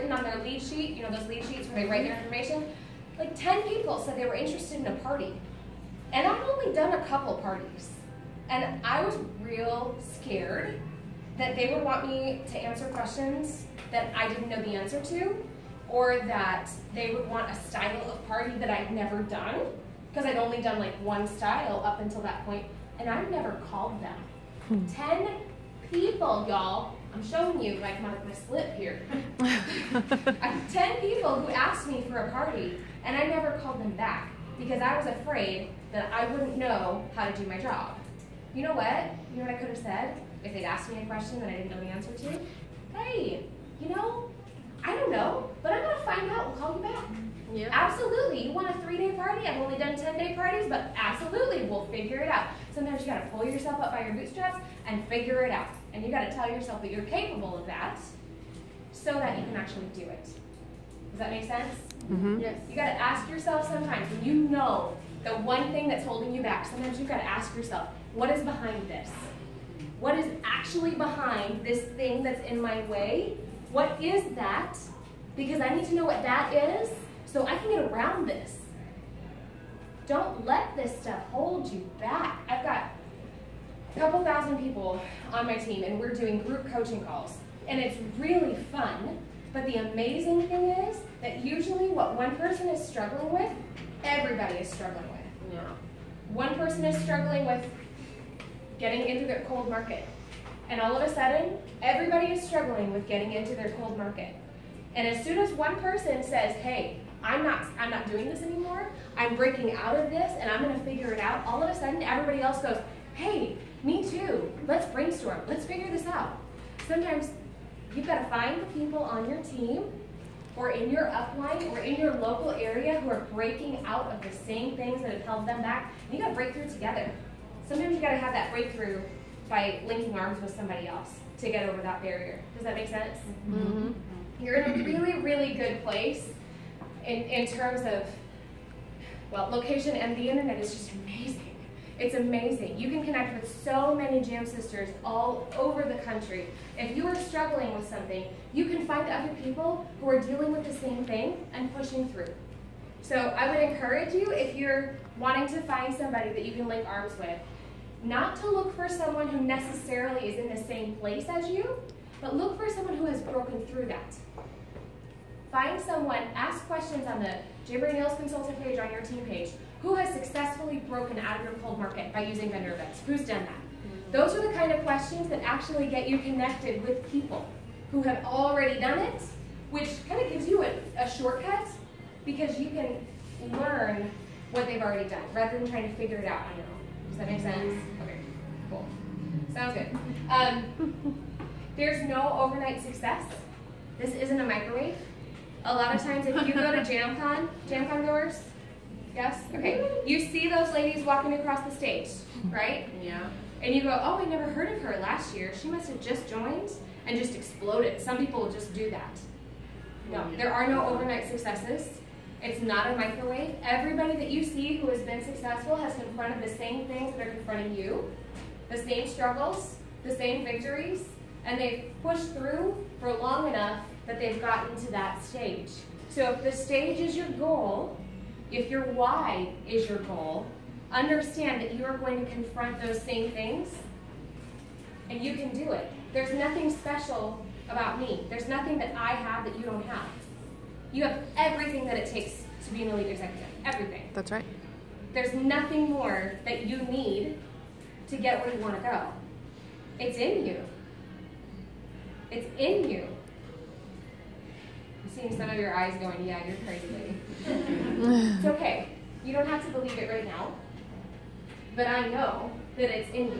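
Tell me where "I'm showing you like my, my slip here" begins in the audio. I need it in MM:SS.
00:27.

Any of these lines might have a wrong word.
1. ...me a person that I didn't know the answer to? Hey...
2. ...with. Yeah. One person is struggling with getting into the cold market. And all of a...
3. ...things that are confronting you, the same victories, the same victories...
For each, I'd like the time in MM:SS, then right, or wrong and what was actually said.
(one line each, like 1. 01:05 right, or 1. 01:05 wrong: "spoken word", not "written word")
1. 00:40 wrong: "question", not "person"
2. 01:35 right
3. 03:36 wrong: "struggles", not "victories".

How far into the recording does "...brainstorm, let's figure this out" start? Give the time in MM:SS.
01:54.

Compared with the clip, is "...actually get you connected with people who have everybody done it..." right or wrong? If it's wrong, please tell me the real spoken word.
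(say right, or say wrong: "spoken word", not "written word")
wrong: "already", not "everybody".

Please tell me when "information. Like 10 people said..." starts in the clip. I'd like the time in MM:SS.
00:02.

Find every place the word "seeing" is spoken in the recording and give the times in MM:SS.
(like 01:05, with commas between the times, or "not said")
04:15.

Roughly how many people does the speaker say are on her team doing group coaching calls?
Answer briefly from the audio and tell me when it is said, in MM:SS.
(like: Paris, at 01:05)
a couple thousand, at 01:23.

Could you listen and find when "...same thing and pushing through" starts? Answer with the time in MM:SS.
02:30.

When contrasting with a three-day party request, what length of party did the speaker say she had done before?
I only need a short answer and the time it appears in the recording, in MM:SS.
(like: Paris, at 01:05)
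10 day, at 00:49.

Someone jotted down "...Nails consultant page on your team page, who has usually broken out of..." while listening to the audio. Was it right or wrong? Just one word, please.
wrong.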